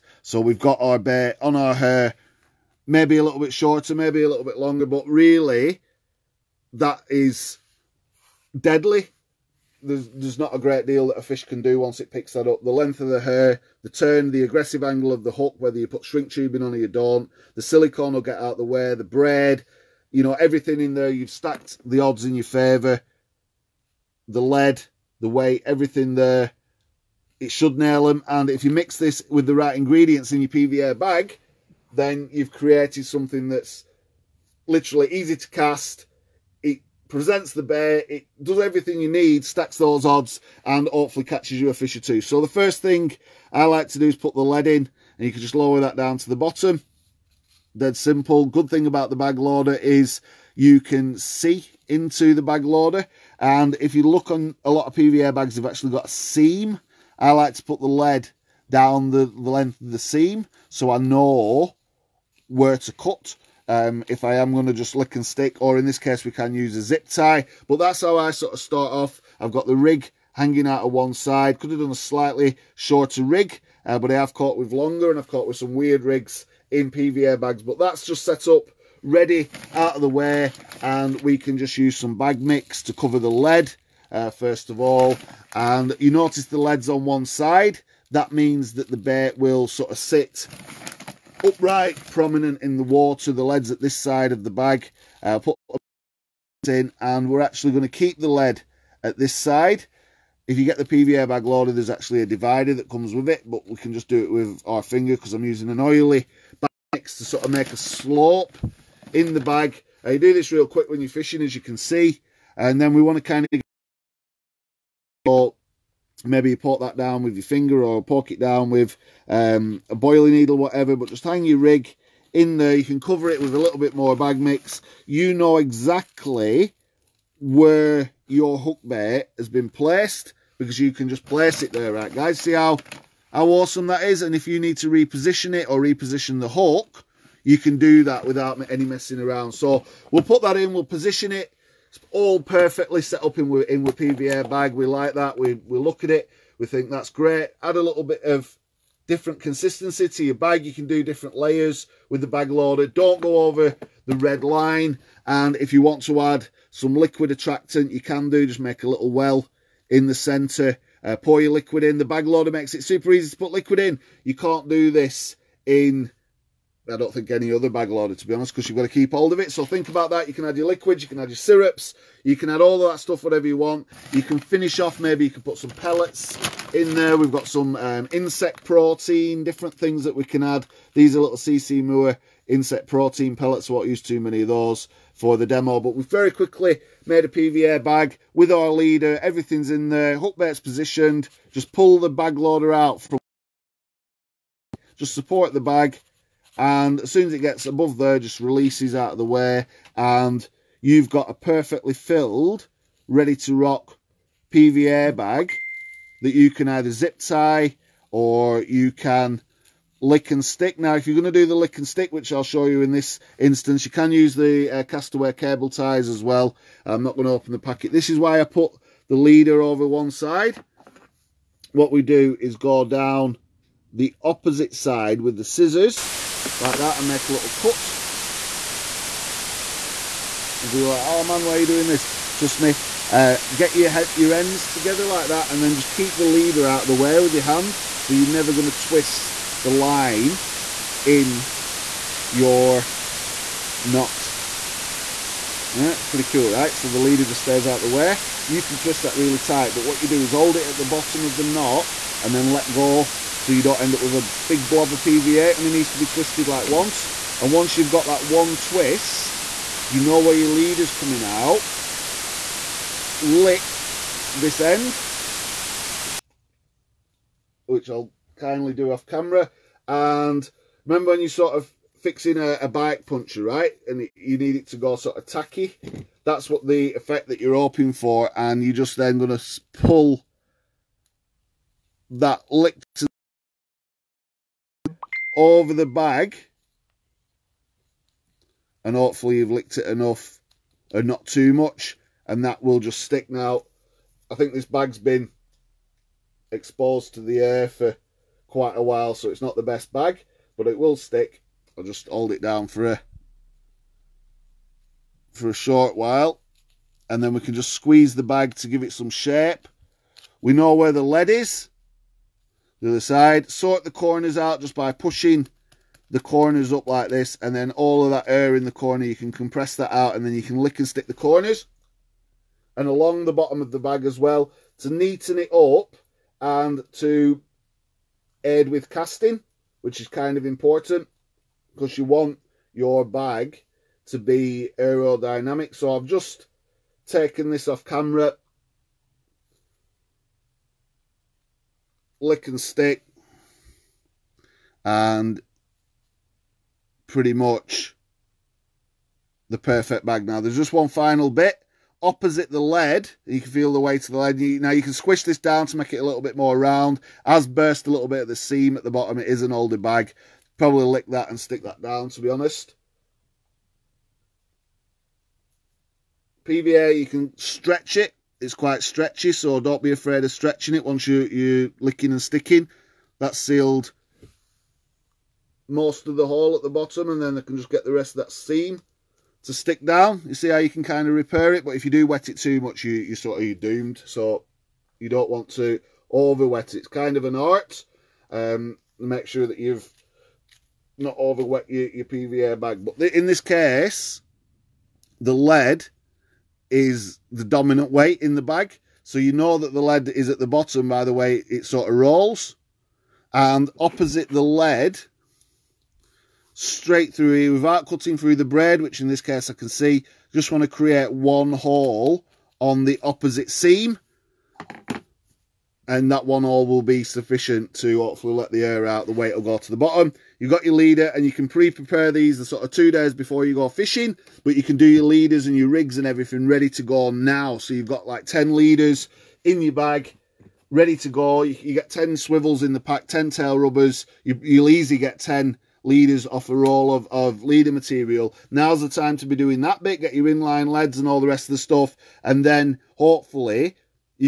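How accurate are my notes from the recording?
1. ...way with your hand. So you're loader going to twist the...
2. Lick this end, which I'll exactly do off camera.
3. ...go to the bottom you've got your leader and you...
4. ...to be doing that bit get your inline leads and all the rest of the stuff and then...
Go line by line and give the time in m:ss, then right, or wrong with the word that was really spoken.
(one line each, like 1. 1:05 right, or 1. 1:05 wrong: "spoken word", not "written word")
1. 3:56 wrong: "never", not "loader"
2. 4:23 wrong: "kindly", not "exactly"
3. 6:59 right
4. 7:19 right.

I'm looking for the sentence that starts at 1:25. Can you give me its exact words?
And you notice the lead's on one side.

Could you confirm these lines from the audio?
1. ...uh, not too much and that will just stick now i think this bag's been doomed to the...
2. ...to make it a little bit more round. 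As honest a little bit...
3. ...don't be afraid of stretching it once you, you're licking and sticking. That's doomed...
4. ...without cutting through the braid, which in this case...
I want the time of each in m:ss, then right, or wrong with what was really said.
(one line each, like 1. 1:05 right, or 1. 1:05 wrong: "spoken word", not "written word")
1. 4:51 wrong: "exposed", not "doomed"
2. 5:55 wrong: "burst", not "honest"
3. 6:09 wrong: "sealed", not "doomed"
4. 6:47 right.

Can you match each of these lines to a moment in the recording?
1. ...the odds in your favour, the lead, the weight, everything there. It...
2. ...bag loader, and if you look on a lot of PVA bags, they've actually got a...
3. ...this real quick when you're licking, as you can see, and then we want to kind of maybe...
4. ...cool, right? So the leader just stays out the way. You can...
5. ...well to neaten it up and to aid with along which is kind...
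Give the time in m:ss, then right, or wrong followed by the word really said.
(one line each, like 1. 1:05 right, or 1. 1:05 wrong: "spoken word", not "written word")
1. 0:21 right
2. 0:52 right
3. 1:50 wrong: "fishing", not "licking"
4. 4:06 right
5. 5:24 wrong: "casting", not "along".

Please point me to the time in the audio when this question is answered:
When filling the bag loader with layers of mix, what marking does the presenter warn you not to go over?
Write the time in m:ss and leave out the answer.
2:34.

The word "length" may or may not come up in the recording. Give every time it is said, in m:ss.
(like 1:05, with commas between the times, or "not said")
0:12, 0:59.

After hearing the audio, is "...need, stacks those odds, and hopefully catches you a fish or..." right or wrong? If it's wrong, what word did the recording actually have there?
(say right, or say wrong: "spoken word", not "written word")
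right.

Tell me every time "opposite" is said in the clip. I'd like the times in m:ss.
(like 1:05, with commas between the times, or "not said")
3:44, 5:52, 6:43, 6:53.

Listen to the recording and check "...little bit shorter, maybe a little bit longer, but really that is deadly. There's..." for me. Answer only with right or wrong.
right.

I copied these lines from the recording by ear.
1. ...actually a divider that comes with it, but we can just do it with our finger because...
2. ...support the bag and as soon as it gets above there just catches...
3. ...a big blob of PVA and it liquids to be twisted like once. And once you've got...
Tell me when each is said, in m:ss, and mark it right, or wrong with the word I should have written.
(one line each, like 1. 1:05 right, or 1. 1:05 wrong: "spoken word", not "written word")
1. 1:41 right
2. 3:15 wrong: "releases", not "catches"
3. 4:14 wrong: "needs", not "liquids".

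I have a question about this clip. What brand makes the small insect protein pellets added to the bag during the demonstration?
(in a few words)
CC Moore.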